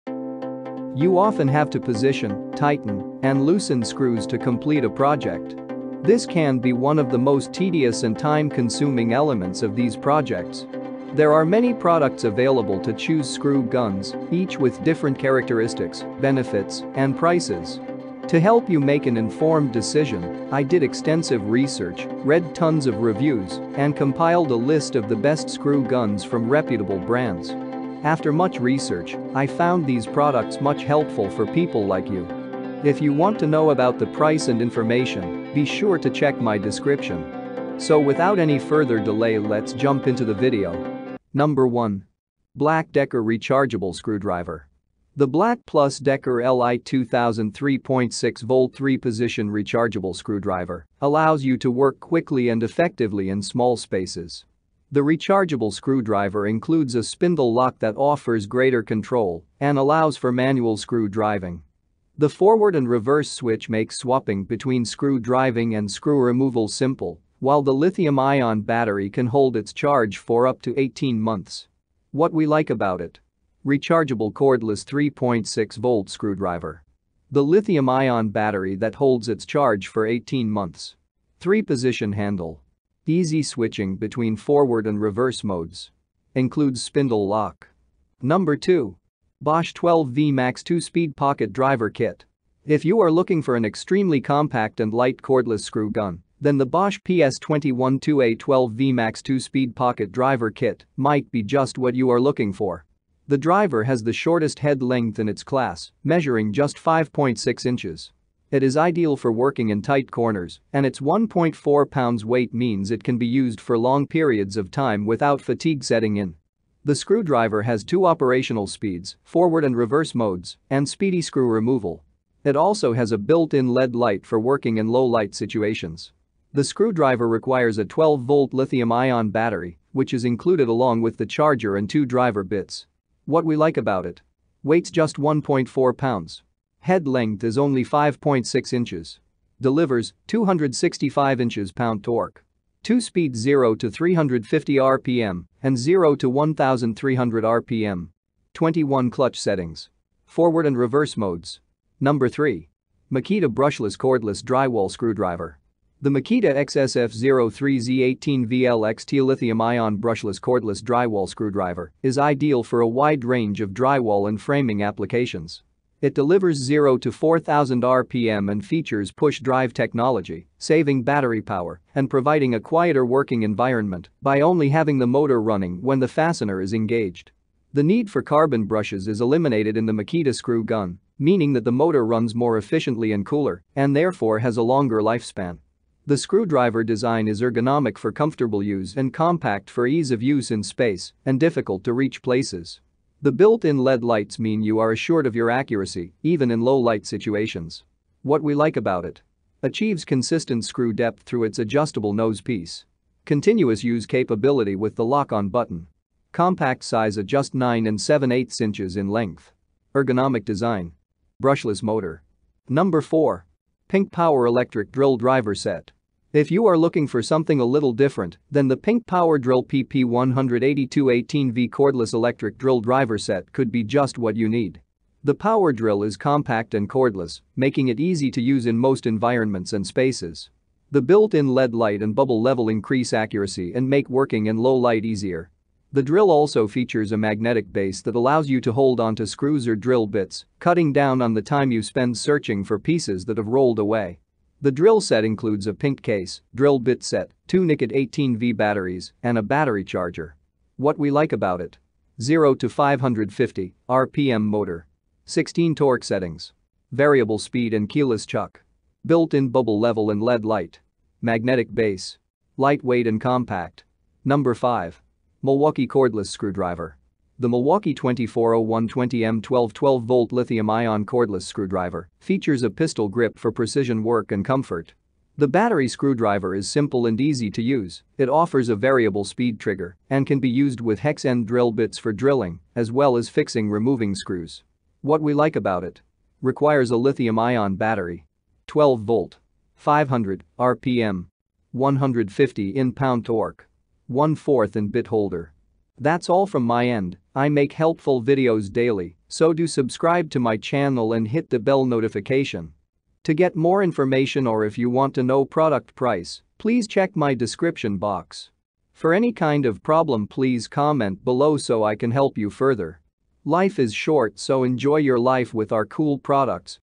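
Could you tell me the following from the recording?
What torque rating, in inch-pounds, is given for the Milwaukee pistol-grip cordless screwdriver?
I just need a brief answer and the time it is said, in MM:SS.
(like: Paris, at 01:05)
150, at 04:51.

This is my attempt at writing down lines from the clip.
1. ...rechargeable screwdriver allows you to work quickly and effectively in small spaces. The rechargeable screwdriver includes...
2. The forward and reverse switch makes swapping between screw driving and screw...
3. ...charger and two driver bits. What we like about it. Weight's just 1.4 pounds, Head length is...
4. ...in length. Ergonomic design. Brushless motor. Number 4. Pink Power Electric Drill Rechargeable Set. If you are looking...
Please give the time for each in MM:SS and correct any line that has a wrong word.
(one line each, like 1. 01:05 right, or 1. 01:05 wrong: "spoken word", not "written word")
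1. 00:49 right
2. 01:02 right
3. 02:11 right
4. 03:28 wrong: "Driver", not "Rechargeable".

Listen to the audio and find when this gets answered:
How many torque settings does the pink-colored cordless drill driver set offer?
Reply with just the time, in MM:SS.
04:15.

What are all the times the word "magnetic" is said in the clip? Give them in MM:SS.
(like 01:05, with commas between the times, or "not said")
03:57, 04:21.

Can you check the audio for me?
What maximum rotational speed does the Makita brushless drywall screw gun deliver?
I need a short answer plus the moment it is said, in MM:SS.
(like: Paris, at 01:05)
4000 RPM, at 02:47.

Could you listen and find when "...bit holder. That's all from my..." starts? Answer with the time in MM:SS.
04:54.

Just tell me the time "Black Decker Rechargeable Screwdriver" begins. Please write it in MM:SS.
00:42.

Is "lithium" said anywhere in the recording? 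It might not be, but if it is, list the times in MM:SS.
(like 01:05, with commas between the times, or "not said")
01:07, 01:17, 02:08, 02:39, 04:30, 04:46.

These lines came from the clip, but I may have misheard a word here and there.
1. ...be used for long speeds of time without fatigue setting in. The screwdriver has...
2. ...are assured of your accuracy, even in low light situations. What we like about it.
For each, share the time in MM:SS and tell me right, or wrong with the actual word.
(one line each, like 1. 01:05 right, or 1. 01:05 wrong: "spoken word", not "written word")
1. 01:53 wrong: "periods", not "speeds"
2. 03:14 right.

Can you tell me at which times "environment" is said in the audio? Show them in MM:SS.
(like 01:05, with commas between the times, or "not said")
02:53, 03:49.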